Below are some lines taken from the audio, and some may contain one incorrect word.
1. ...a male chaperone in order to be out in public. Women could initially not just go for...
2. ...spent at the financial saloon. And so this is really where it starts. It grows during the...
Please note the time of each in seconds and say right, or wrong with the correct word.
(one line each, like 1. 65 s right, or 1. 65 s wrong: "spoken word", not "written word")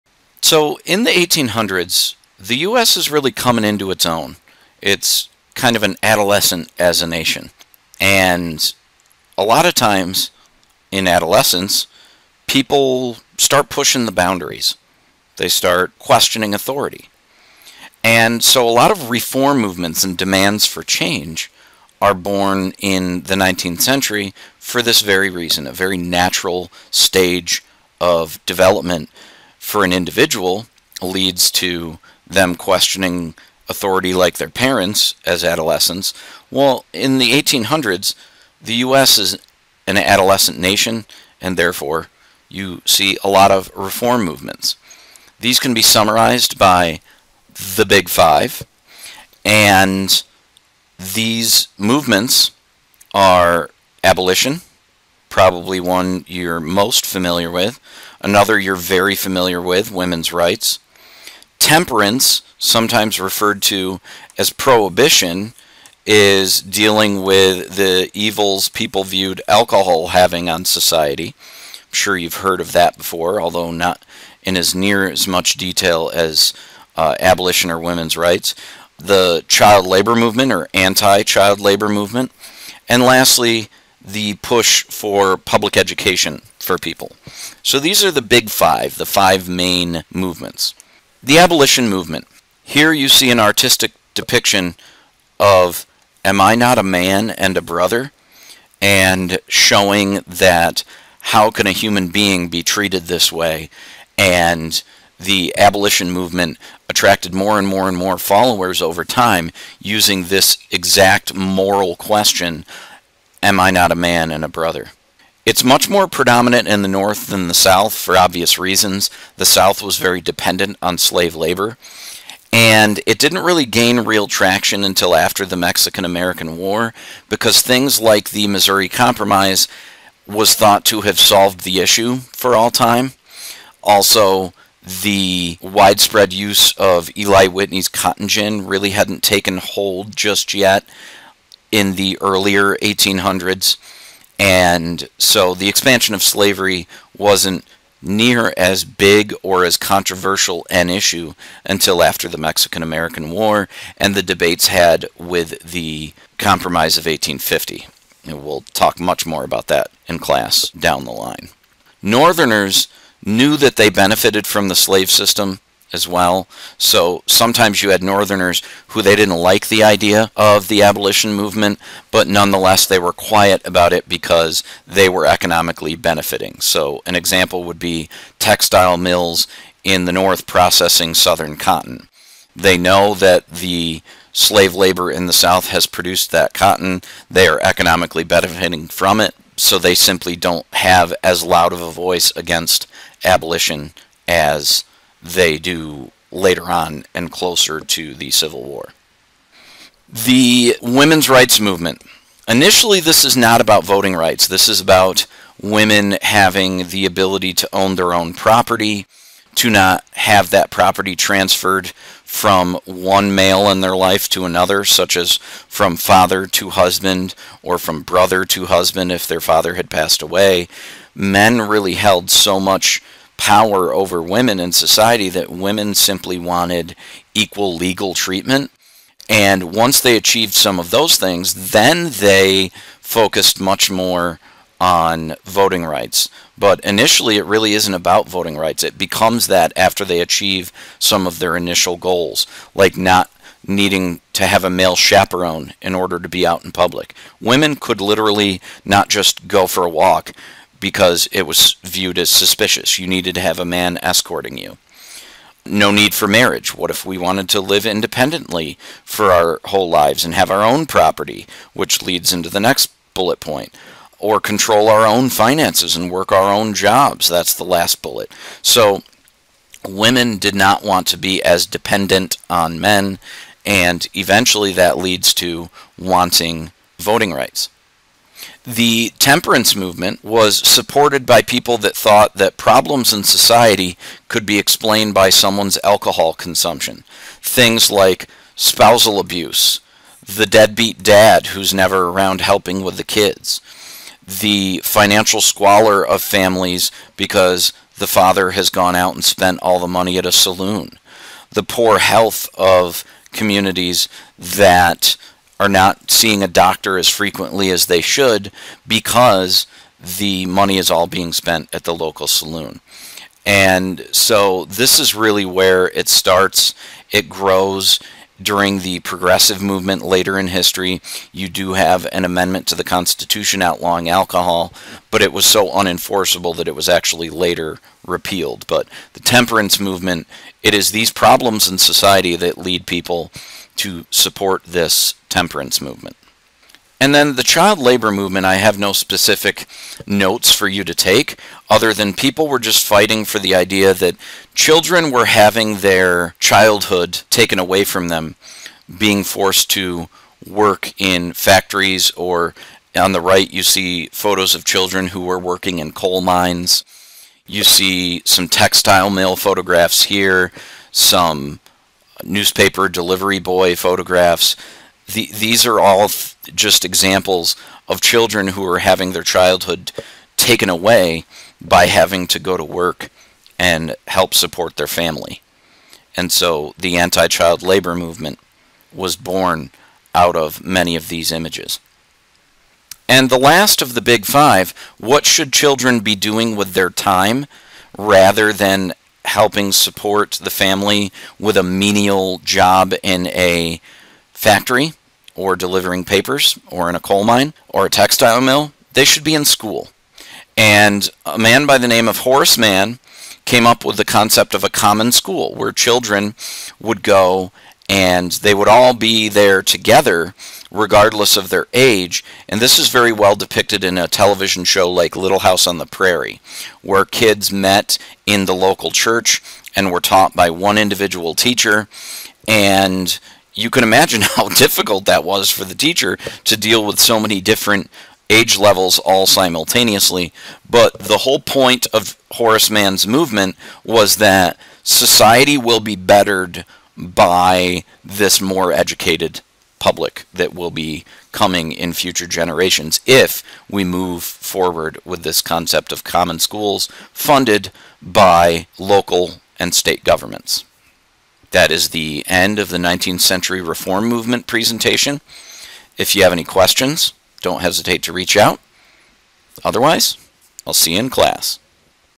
1. 244 s wrong: "literally", not "initially"
2. 311 s wrong: "local", not "financial".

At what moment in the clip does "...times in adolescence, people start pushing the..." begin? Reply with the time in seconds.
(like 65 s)
9 s.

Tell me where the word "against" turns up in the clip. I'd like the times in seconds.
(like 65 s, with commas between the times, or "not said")
192 s.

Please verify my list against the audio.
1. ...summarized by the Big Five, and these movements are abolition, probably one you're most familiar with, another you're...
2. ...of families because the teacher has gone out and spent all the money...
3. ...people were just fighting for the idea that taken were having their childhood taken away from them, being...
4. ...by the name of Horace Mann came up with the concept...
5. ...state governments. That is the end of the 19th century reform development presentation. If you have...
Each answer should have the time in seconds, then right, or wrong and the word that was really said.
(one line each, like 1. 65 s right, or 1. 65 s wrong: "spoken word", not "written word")
1. 45 s right
2. 296 s wrong: "father", not "teacher"
3. 342 s wrong: "children", not "taken"
4. 401 s right
5. 449 s wrong: "movement", not "development".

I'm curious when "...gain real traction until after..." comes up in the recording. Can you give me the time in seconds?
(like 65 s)
123 s.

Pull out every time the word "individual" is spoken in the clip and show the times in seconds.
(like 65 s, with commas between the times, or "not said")
29 s, 420 s.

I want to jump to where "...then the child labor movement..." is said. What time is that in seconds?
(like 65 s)
337 s.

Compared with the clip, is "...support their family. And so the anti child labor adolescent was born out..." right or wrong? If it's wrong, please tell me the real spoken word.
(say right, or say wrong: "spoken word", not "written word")
wrong: "movement", not "adolescent".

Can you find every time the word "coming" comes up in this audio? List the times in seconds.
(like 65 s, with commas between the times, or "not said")
3 s, 441 s.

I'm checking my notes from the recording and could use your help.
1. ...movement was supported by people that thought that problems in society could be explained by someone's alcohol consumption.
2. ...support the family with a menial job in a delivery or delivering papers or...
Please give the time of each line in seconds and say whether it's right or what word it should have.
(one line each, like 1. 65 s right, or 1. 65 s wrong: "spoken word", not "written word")
1. 279 s right
2. 389 s wrong: "factory", not "delivery".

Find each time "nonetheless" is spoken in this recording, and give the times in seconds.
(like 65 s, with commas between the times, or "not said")
172 s.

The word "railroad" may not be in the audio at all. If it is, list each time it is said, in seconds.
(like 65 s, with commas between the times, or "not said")
not said.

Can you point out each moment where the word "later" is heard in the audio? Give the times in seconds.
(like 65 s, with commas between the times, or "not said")
196 s, 320 s, 327 s.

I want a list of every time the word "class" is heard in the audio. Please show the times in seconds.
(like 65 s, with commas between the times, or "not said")
160 s, 461 s.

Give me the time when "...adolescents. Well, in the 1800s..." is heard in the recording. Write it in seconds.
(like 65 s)
35 s.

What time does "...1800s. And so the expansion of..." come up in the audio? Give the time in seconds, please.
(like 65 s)
142 s.